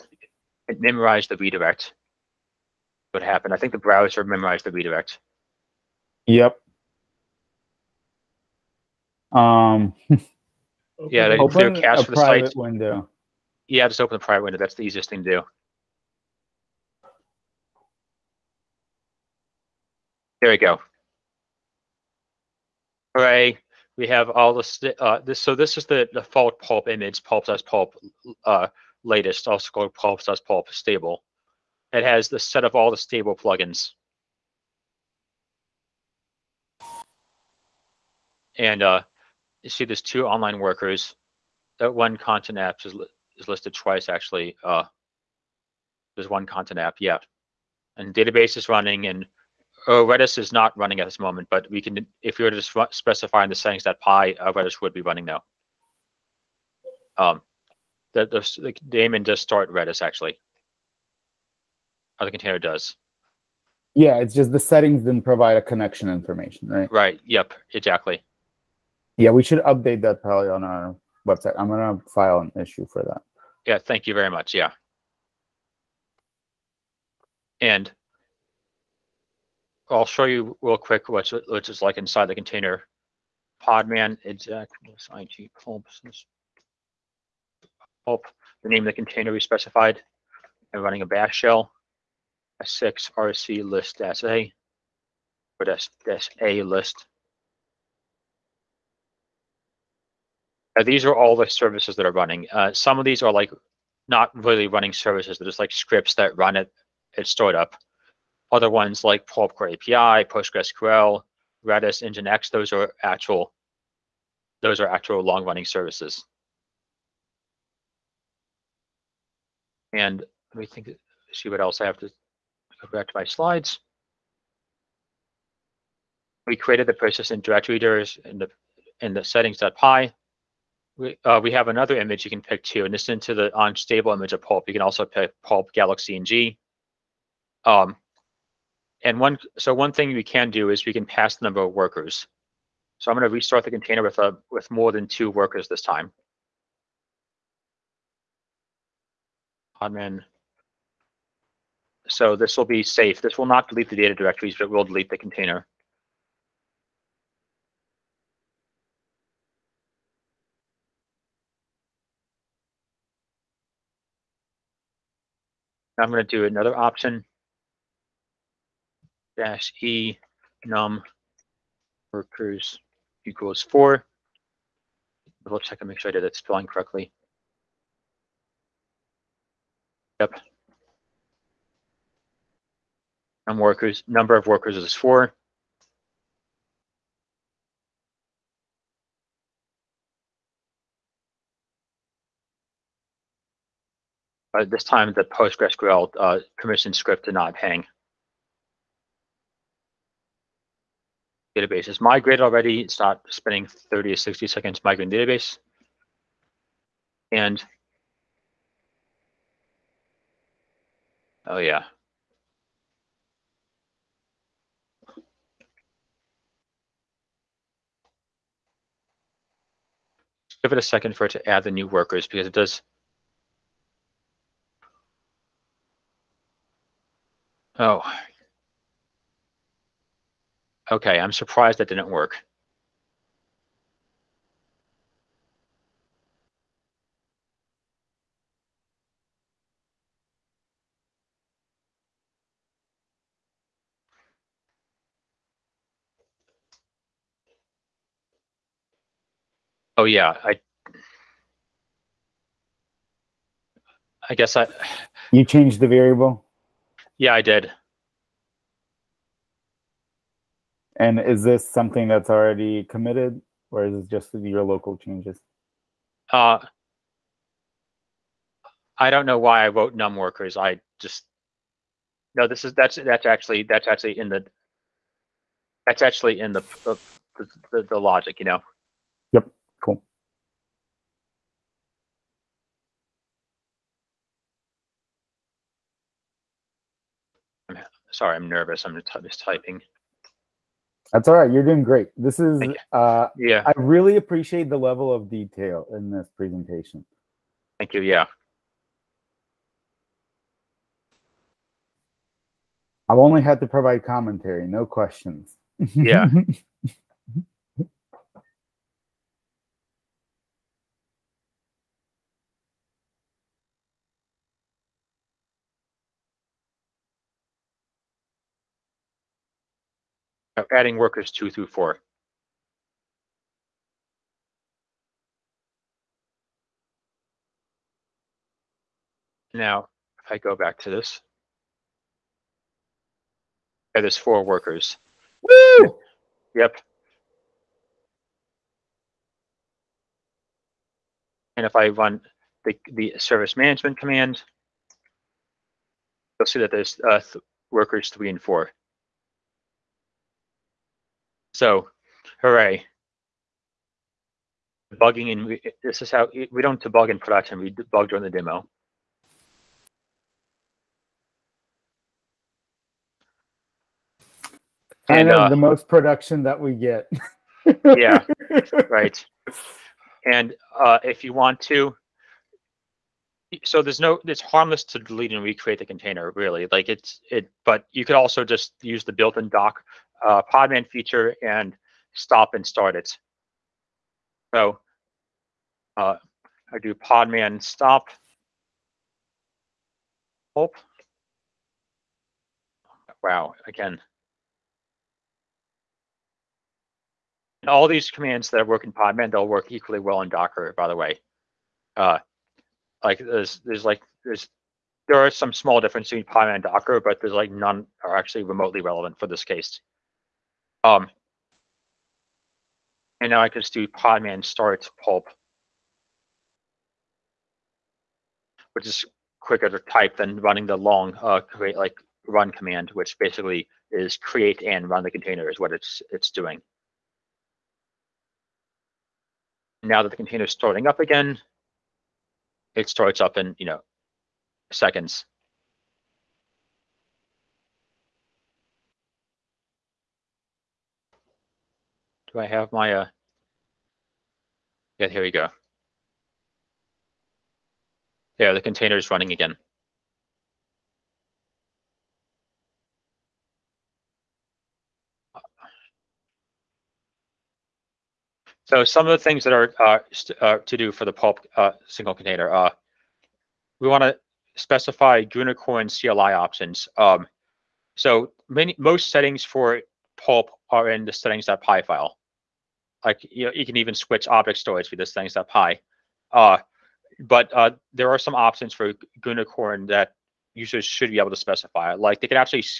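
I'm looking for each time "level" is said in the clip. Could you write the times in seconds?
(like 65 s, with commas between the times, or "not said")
294 s.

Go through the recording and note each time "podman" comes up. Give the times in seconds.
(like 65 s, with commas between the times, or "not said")
83 s, 380 s, 386 s, 398 s, 406 s, 413 s.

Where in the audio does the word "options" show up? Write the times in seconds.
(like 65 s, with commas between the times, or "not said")
166 s, 466 s, 478 s.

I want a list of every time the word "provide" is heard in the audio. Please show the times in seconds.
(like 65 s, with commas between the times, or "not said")
65 s, 303 s.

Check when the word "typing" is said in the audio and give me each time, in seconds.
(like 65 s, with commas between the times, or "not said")
289 s.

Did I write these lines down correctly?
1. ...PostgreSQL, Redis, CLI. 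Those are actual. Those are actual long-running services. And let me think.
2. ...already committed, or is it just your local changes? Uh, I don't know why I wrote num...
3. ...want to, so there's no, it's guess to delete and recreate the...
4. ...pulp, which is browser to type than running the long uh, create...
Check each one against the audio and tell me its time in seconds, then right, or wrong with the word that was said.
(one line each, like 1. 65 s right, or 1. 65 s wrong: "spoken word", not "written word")
1. 110 s wrong: "Nginx", not "CLI"
2. 262 s right
3. 371 s wrong: "harmless", not "guess"
4. 415 s wrong: "quicker", not "browser".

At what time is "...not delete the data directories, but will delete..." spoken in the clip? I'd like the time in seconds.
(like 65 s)
153 s.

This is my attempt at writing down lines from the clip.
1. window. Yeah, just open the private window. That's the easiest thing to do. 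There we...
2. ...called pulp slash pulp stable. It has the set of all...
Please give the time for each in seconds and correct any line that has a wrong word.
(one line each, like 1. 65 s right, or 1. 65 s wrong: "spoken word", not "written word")
1. 12 s right
2. 29 s right.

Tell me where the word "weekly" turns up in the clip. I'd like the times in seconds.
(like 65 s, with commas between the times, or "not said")
not said.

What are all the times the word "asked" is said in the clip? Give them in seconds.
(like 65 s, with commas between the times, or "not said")
not said.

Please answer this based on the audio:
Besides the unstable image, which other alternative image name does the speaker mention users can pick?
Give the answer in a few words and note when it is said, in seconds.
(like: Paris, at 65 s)
galaxy, at 135 s.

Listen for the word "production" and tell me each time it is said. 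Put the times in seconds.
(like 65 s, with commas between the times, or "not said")
357 s, 365 s.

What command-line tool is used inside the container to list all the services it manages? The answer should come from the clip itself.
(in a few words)
S6RC.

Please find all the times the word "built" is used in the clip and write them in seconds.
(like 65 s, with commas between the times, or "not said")
379 s.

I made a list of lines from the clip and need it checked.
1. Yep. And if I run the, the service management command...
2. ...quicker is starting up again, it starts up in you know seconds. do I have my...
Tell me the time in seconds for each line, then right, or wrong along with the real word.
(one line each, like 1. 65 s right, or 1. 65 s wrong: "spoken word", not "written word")
1. 336 s right
2. 430 s wrong: "container", not "quicker".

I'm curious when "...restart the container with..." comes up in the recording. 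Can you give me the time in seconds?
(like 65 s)
143 s.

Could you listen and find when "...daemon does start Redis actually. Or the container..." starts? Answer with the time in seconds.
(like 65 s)
58 s.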